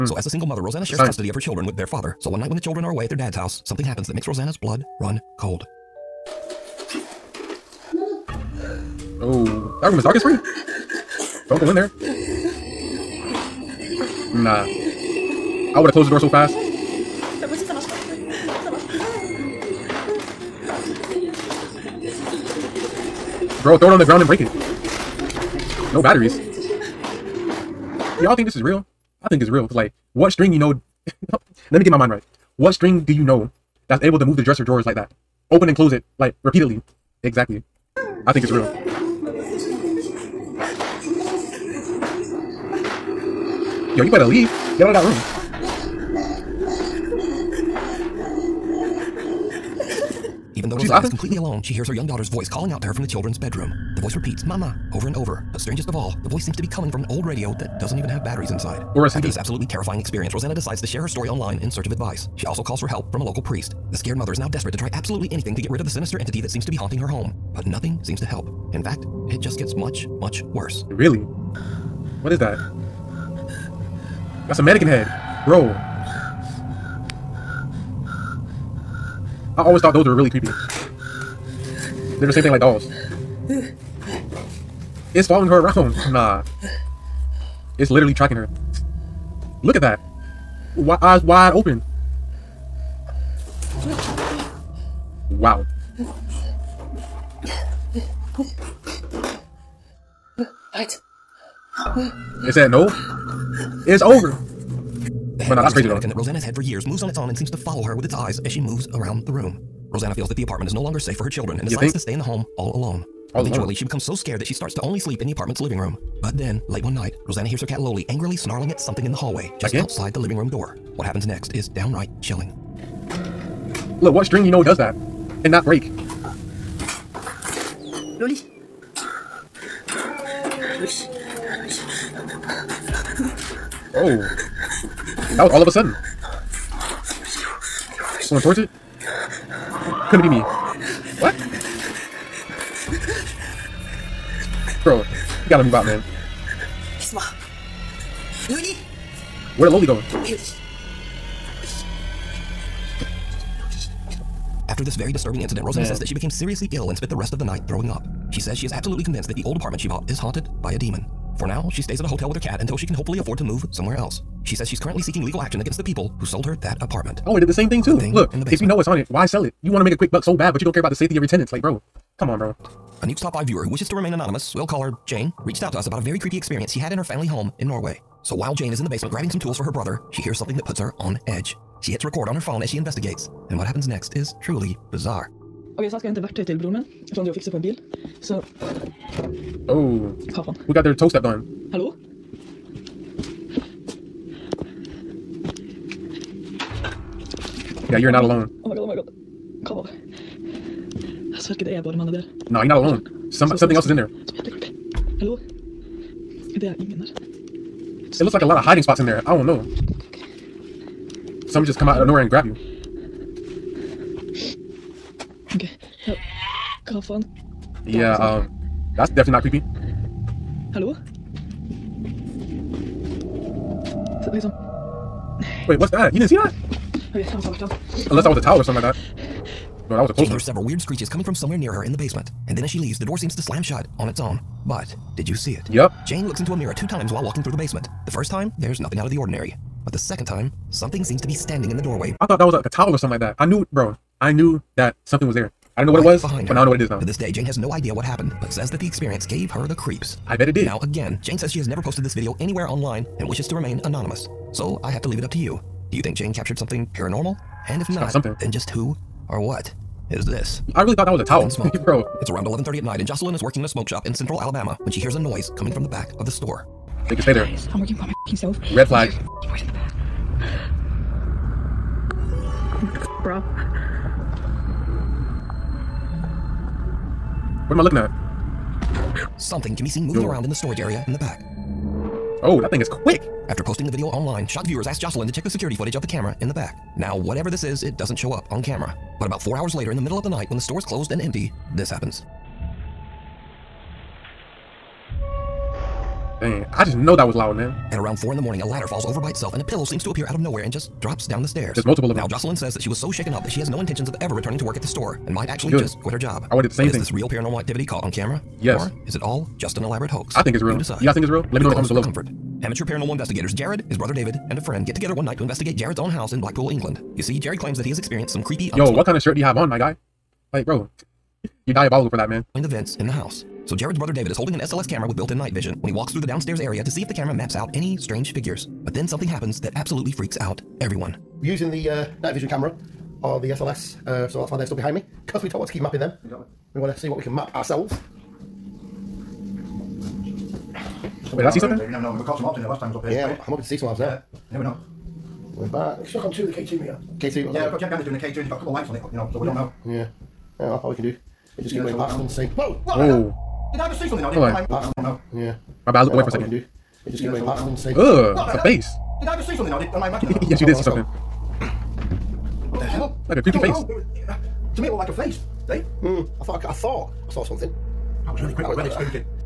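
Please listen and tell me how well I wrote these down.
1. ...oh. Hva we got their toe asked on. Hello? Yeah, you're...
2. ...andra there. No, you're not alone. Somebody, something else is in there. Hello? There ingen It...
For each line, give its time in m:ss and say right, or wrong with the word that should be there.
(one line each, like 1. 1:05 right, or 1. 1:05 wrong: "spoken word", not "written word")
1. 3:09 wrong: "stepped", not "asked"
2. 3:21 right.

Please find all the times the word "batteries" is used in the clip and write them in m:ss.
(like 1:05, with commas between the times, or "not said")
0:26, 0:58.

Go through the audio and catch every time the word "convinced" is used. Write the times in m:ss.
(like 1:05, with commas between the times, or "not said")
2:39.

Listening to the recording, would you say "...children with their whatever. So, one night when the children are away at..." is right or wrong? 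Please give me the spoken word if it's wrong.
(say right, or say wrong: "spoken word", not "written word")
wrong: "father", not "whatever".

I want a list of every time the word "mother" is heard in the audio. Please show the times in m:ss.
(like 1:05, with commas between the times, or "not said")
0:00, 1:04.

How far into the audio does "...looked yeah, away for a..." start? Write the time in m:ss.
5:56.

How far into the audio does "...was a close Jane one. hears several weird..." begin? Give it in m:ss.
3:50.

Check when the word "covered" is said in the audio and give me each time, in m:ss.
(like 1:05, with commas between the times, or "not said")
not said.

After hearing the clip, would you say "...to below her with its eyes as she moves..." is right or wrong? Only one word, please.
wrong.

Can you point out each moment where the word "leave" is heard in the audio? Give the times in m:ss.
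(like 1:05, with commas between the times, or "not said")
0:44, 3:52, 4:15.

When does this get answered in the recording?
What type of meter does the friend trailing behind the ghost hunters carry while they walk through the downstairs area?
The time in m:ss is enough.
5:46.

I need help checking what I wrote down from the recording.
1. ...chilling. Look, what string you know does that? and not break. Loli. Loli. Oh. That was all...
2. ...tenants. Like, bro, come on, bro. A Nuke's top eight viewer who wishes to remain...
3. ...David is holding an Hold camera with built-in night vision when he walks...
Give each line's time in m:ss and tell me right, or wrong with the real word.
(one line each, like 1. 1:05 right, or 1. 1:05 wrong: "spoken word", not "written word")
1. 2:02 right
2. 2:51 wrong: "five", not "eight"
3. 5:24 wrong: "SLS", not "Hold".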